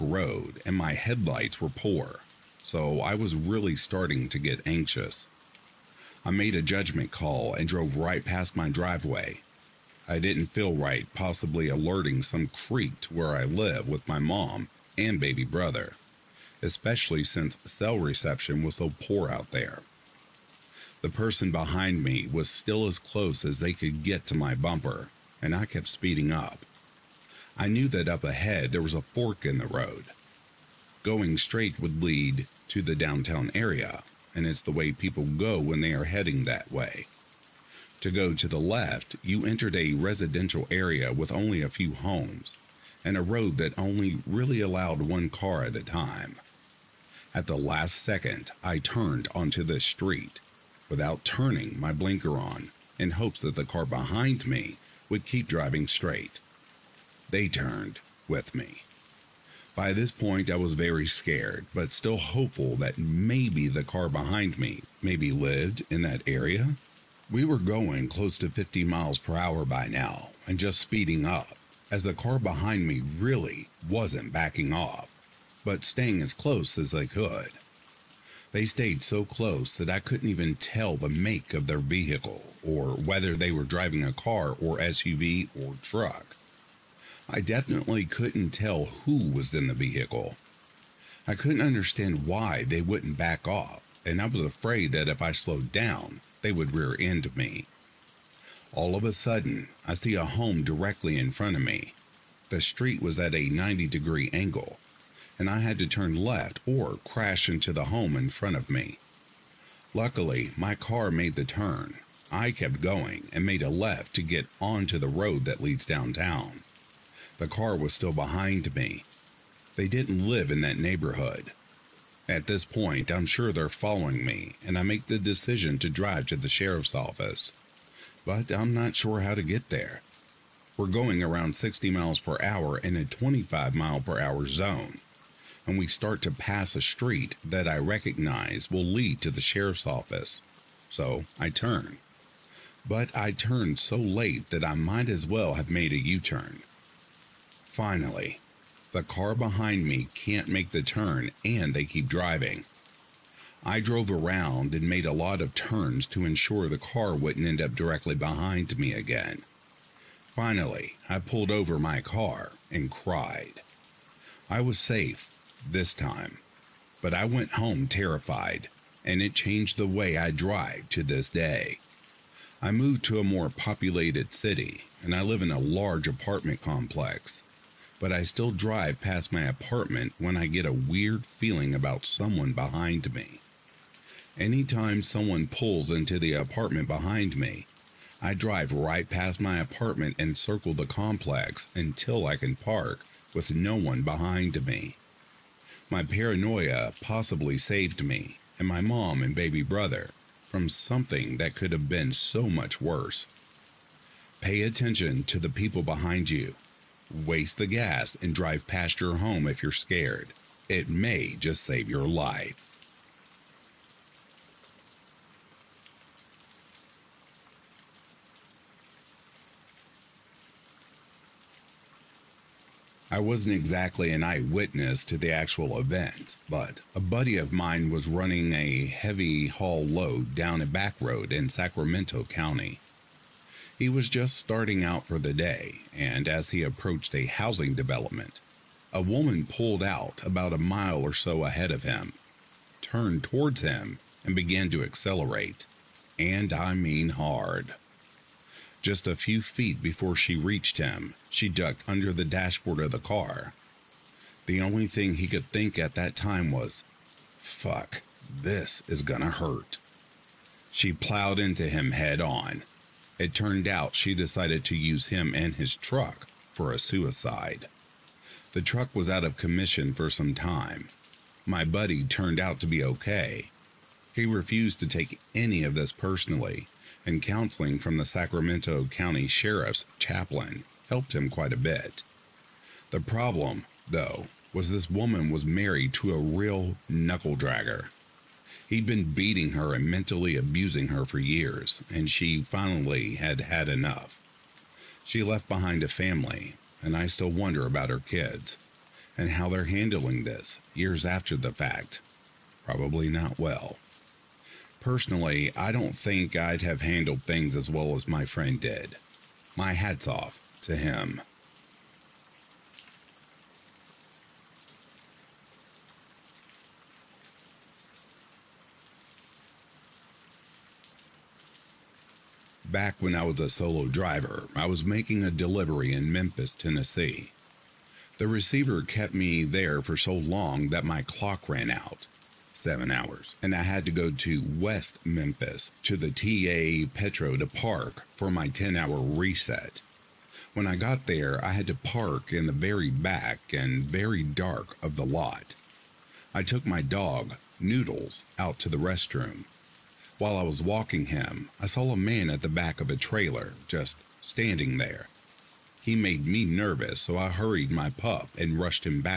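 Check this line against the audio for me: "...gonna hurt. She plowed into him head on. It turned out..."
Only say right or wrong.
right.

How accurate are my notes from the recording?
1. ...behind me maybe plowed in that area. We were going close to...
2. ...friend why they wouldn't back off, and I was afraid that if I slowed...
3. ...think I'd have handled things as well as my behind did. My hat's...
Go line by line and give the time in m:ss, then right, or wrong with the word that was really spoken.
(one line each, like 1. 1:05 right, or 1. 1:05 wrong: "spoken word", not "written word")
1. 1:04 wrong: "lived", not "plowed"
2. 1:31 wrong: "understand", not "friend"
3. 5:05 wrong: "friend", not "behind".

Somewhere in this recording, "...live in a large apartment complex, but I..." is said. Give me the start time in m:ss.
2:55.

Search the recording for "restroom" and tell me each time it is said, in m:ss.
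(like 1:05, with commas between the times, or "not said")
5:48.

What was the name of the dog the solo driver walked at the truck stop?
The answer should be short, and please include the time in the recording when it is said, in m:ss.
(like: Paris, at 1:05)
Noodles, at 5:47.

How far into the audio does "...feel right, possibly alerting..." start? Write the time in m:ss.
0:10.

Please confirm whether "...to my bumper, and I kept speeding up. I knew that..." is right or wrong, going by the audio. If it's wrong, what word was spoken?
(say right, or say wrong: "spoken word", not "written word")
right.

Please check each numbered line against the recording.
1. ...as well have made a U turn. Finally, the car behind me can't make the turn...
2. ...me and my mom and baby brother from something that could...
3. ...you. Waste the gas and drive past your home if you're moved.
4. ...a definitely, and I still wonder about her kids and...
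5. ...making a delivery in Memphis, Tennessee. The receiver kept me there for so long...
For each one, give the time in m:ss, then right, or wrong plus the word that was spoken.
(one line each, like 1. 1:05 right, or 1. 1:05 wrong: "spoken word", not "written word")
1. 2:25 right
2. 3:18 right
3. 3:26 wrong: "scared", not "moved"
4. 4:55 wrong: "family", not "definitely"
5. 5:24 right.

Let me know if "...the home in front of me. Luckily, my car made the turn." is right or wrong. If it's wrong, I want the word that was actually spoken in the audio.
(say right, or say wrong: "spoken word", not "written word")
right.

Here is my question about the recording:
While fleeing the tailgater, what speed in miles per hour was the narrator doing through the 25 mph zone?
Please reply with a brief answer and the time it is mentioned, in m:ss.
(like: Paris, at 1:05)
60, at 2:11.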